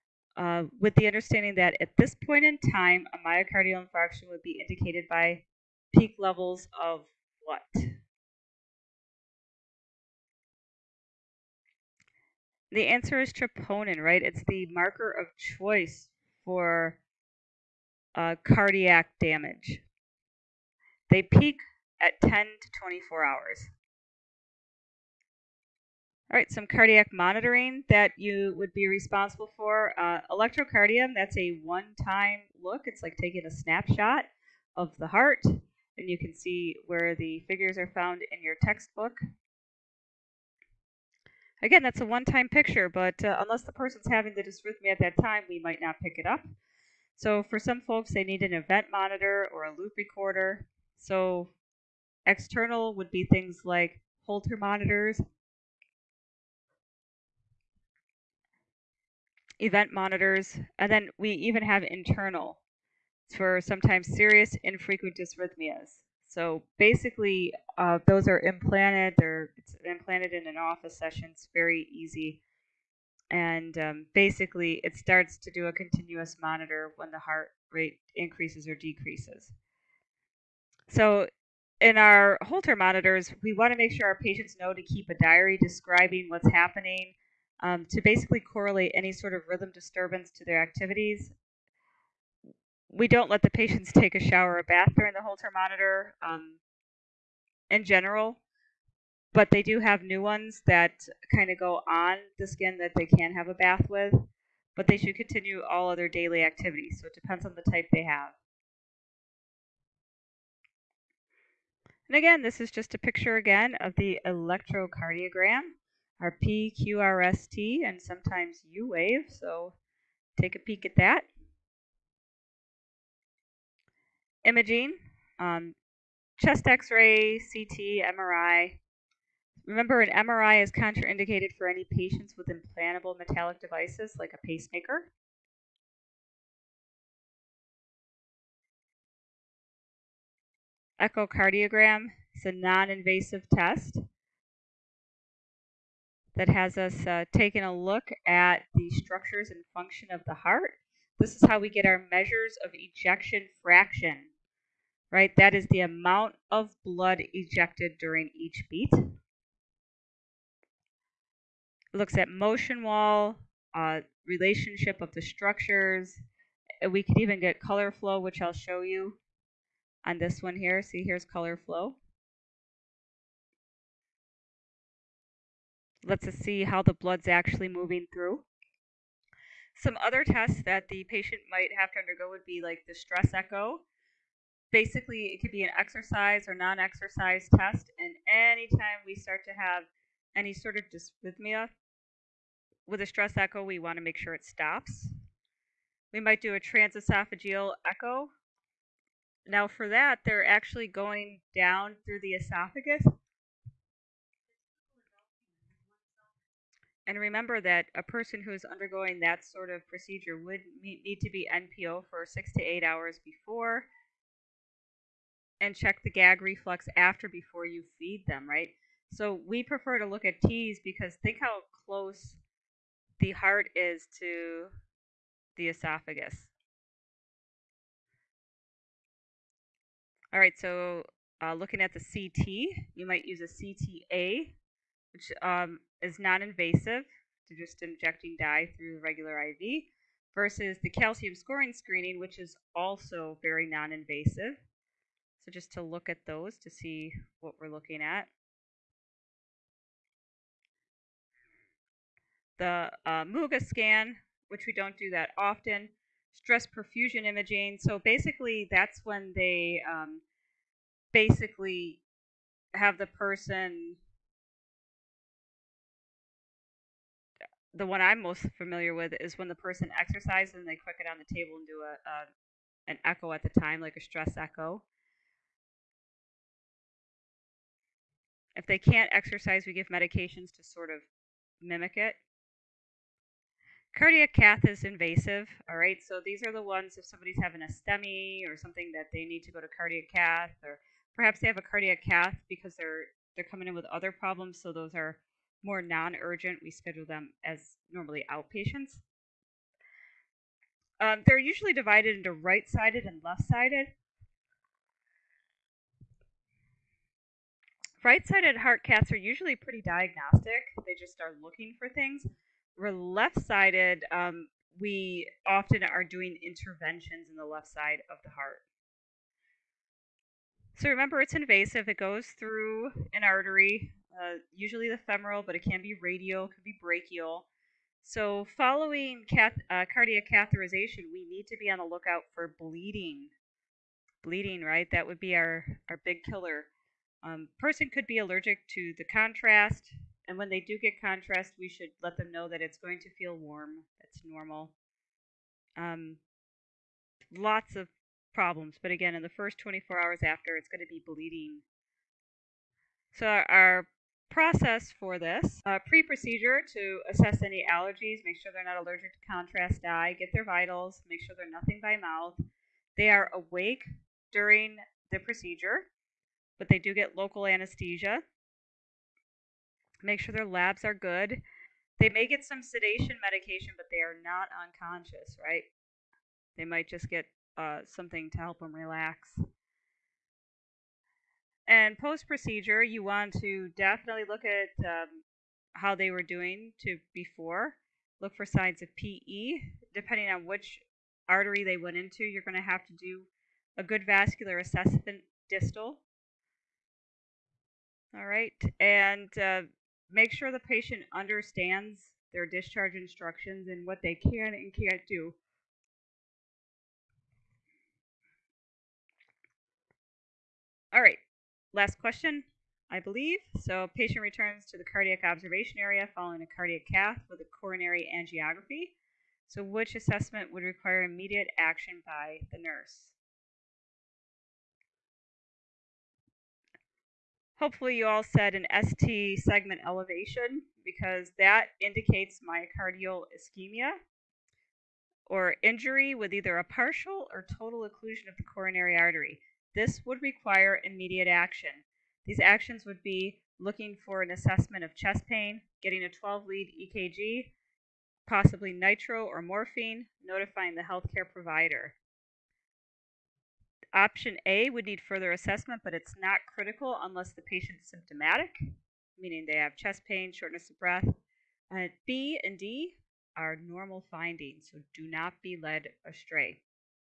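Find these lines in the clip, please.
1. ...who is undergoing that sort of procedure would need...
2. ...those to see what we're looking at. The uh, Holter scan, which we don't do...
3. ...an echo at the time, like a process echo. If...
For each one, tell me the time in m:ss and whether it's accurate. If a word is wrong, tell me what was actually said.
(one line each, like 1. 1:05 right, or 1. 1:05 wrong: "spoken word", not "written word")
1. 3:28 right
2. 4:06 wrong: "MUGA", not "Holter"
3. 4:32 wrong: "stress", not "process".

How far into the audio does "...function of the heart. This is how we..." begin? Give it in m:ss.
2:29.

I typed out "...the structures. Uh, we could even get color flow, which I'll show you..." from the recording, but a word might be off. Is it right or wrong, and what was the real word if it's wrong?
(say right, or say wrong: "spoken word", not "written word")
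right.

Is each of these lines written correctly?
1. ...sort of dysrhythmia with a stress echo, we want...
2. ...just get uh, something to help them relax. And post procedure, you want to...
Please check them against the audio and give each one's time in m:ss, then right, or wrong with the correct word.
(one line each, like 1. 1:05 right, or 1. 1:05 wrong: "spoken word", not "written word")
1. 3:10 right
2. 6:16 right.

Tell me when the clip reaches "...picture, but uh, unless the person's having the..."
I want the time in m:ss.
0:42.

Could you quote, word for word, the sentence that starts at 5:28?
So, following cath- uh, cardiac catheterization, we need to be on the lookout for bleeding.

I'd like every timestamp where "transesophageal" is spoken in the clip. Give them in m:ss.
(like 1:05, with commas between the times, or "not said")
3:16.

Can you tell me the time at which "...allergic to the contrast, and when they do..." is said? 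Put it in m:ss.
5:38.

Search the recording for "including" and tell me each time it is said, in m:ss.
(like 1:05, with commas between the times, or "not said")
not said.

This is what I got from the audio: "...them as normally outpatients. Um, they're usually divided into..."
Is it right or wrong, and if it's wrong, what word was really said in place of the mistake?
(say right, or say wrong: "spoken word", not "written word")
right.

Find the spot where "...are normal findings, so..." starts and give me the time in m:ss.
7:43.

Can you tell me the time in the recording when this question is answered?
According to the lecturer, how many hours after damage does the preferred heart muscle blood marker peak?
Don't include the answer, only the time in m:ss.
0:22.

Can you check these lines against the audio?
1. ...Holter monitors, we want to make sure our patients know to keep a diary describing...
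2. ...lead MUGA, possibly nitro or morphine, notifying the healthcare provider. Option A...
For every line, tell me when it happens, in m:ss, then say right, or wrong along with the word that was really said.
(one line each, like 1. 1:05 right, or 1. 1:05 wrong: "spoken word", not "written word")
1. 1:22 right
2. 7:26 wrong: "EKG", not "MUGA".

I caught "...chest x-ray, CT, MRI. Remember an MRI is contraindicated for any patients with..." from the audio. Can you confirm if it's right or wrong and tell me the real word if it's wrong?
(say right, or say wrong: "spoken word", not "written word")
right.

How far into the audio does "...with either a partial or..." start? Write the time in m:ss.
7:16.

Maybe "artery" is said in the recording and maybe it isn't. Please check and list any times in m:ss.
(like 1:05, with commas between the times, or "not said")
5:23, 6:31, 7:18.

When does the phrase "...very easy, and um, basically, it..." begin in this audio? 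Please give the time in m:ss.
1:11.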